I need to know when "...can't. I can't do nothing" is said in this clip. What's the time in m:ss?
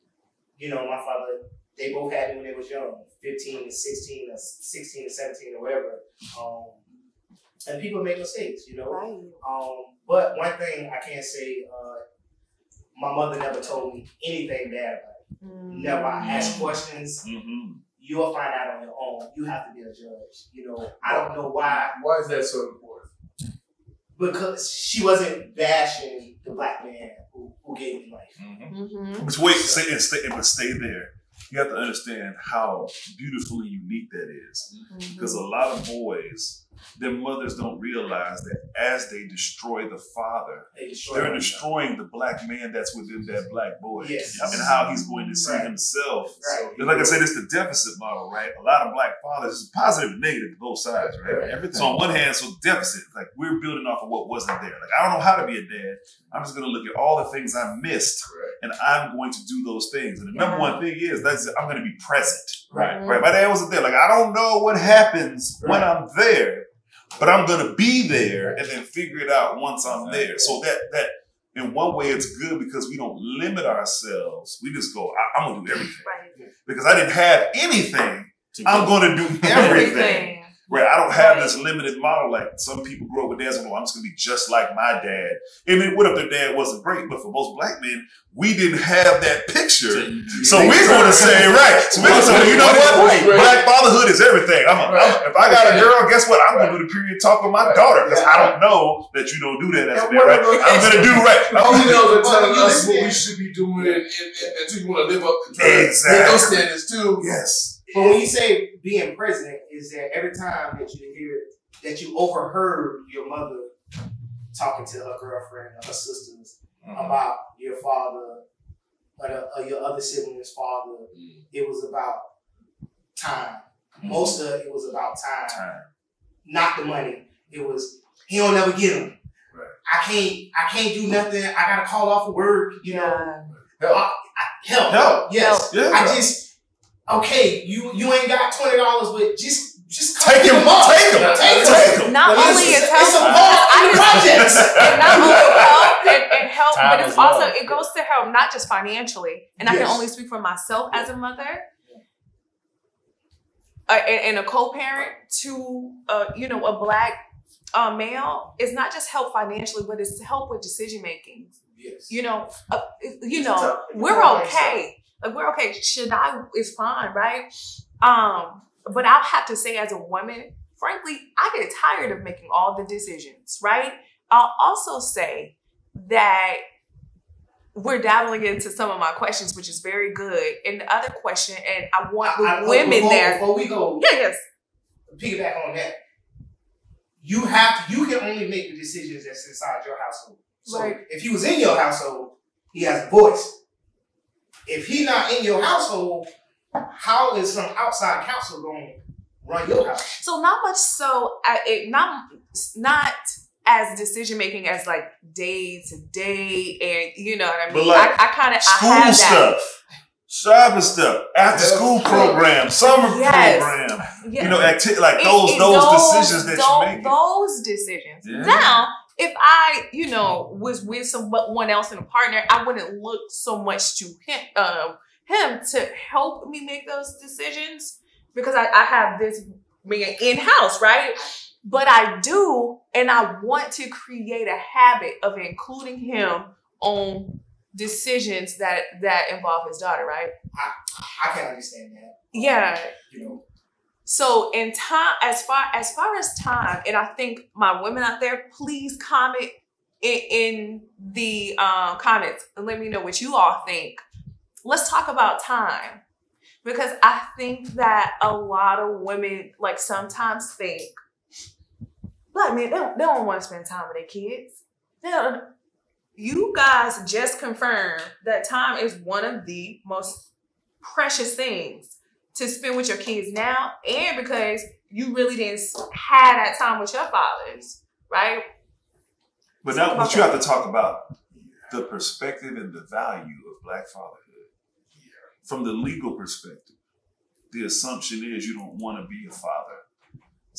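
2:10.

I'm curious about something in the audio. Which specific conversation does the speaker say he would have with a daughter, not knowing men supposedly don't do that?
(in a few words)
the period talk.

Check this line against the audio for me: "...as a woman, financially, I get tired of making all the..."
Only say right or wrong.
wrong.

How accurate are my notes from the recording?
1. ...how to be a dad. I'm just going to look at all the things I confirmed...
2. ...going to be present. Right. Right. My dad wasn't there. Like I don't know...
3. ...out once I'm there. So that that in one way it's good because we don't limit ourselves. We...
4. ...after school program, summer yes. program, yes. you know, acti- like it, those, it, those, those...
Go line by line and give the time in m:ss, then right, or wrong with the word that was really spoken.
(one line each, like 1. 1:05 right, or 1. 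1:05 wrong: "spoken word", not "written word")
1. 0:55 wrong: "missed", not "confirmed"
2. 1:01 right
3. 1:09 right
4. 3:31 right.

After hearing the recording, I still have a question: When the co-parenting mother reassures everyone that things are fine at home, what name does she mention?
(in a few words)
Shadai.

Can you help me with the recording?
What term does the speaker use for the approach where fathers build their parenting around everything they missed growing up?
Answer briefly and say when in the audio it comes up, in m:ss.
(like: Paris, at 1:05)
deficit model, at 0:47.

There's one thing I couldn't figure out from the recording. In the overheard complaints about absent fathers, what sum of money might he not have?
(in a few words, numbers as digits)
$20.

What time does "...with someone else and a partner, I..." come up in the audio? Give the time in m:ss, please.
3:40.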